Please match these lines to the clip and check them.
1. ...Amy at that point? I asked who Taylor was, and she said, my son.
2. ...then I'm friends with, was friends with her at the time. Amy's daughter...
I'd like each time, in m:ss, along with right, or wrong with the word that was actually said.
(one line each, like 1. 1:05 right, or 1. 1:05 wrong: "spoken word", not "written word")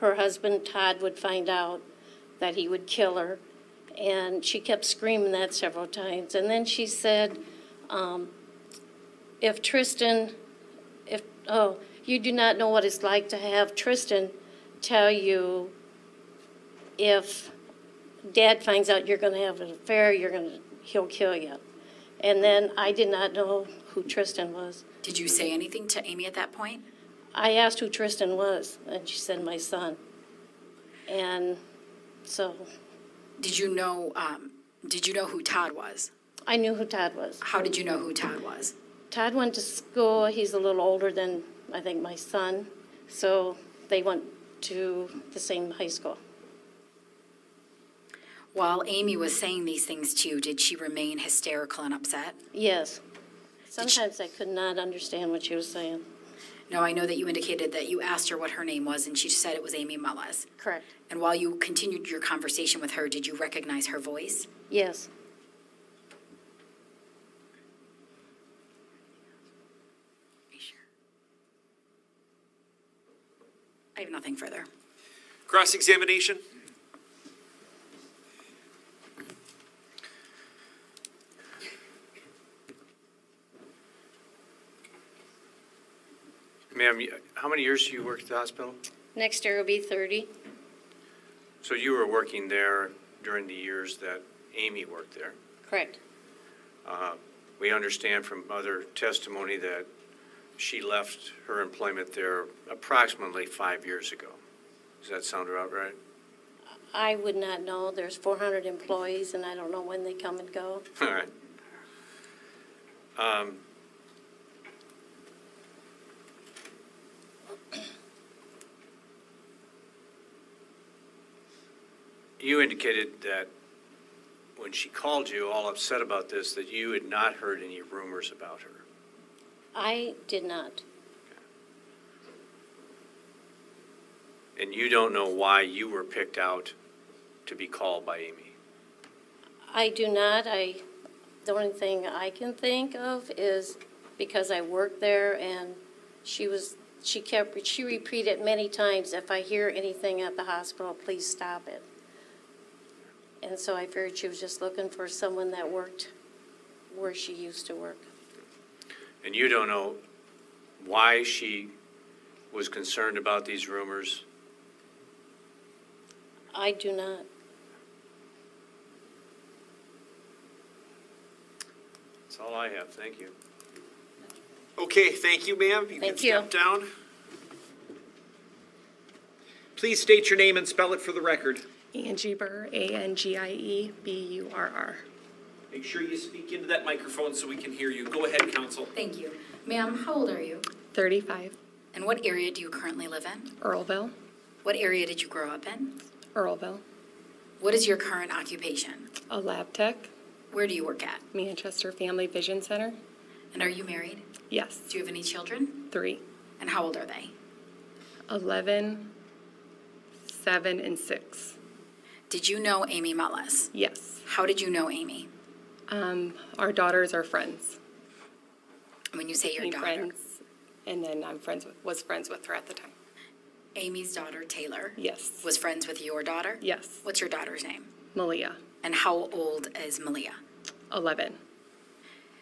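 1. 0:26 wrong: "Tristan", not "Taylor"
2. 3:41 right.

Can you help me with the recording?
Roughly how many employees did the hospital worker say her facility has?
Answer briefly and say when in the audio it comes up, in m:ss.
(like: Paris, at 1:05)
400, at 1:48.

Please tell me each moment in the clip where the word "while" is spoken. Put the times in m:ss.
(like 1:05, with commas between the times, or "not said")
0:48, 1:01.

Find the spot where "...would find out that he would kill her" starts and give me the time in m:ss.
0:01.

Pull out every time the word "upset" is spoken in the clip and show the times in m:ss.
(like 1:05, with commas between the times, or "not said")
0:51, 2:05.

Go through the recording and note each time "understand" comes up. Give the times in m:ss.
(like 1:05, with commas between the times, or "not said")
0:54, 1:37.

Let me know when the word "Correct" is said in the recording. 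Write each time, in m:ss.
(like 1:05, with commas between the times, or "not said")
1:00, 1:35.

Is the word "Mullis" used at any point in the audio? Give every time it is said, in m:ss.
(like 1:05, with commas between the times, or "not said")
0:59, 3:33.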